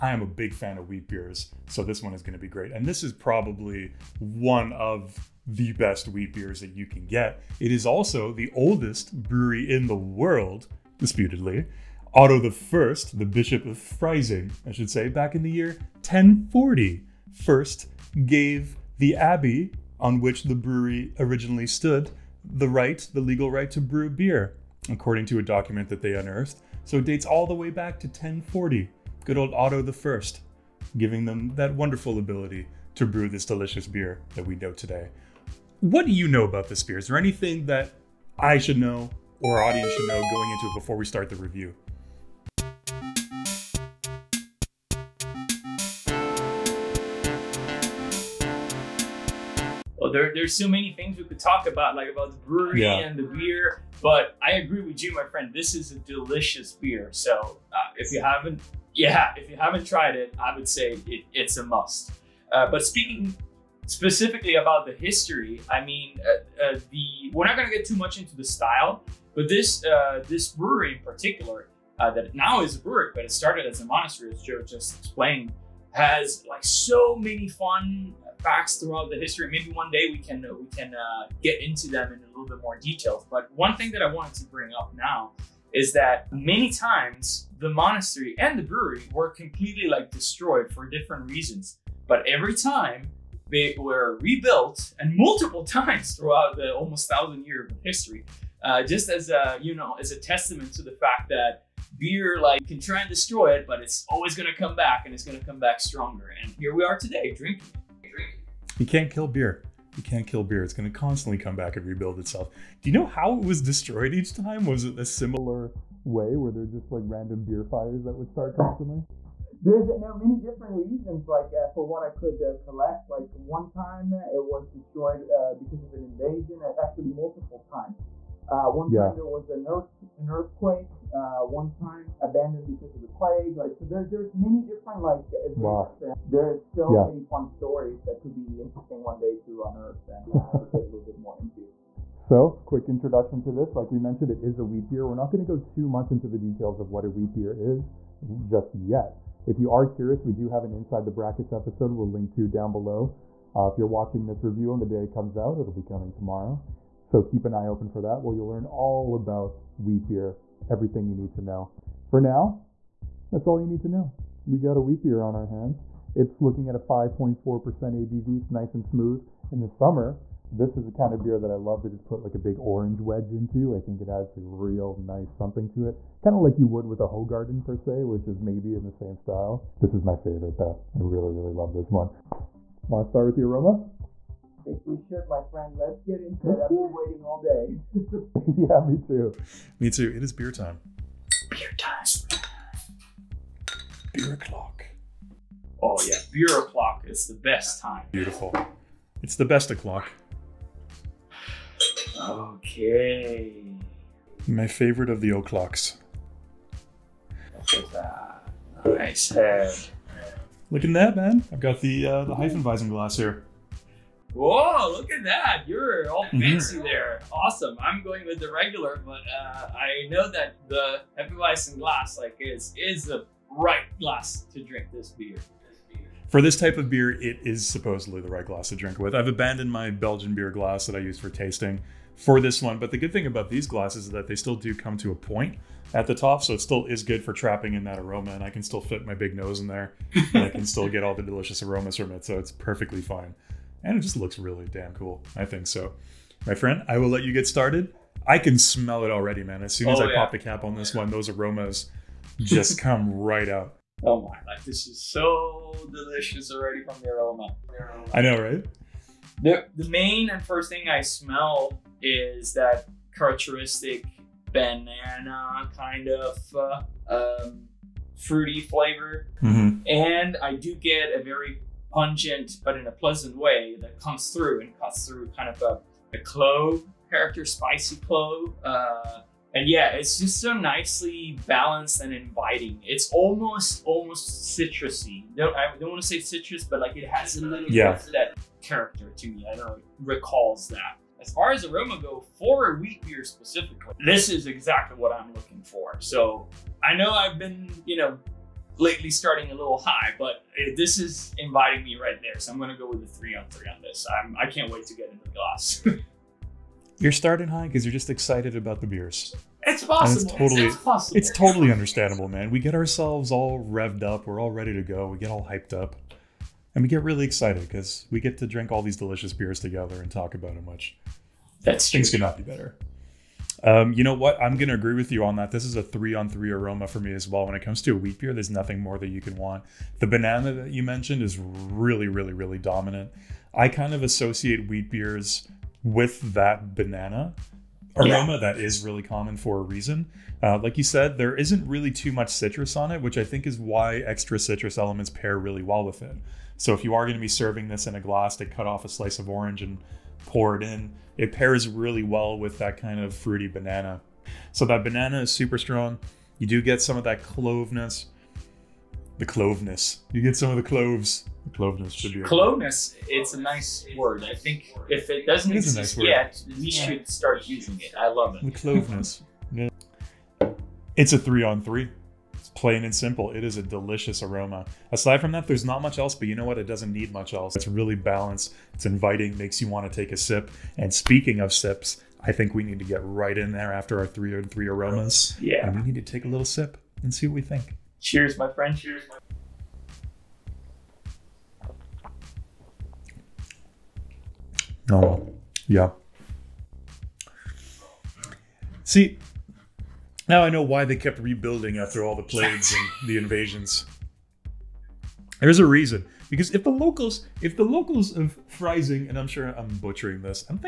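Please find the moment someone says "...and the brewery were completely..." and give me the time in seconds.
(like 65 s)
88 s.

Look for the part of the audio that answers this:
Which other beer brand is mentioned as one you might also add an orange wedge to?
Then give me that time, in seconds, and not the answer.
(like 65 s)
177 s.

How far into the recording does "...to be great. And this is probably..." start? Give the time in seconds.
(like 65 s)
2 s.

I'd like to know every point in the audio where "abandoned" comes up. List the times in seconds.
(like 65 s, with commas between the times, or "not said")
132 s, 229 s.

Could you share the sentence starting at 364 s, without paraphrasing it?
I think if it doesn't it exist nice yet, we yeah.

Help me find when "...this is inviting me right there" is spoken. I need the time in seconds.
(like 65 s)
300 s.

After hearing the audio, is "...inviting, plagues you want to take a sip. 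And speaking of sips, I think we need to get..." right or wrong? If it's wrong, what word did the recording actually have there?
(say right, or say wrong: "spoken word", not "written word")
wrong: "makes", not "plagues".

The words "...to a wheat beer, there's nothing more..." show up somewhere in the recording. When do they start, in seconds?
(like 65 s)
327 s.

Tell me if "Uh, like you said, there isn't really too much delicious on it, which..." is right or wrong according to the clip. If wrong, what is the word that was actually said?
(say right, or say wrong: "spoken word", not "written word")
wrong: "citrus", not "delicious".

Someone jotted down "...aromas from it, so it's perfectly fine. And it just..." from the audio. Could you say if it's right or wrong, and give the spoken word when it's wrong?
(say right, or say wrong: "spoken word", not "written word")
right.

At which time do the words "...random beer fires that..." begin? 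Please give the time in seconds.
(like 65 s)
117 s.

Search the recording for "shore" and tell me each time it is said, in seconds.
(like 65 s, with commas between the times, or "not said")
not said.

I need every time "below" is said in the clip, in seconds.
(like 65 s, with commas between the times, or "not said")
152 s.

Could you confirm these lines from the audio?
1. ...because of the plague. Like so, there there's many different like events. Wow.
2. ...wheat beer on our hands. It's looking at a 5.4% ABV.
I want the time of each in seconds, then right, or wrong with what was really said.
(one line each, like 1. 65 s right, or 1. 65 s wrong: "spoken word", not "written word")
1. 132 s right
2. 164 s right.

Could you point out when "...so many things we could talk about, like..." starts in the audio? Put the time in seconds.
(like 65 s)
50 s.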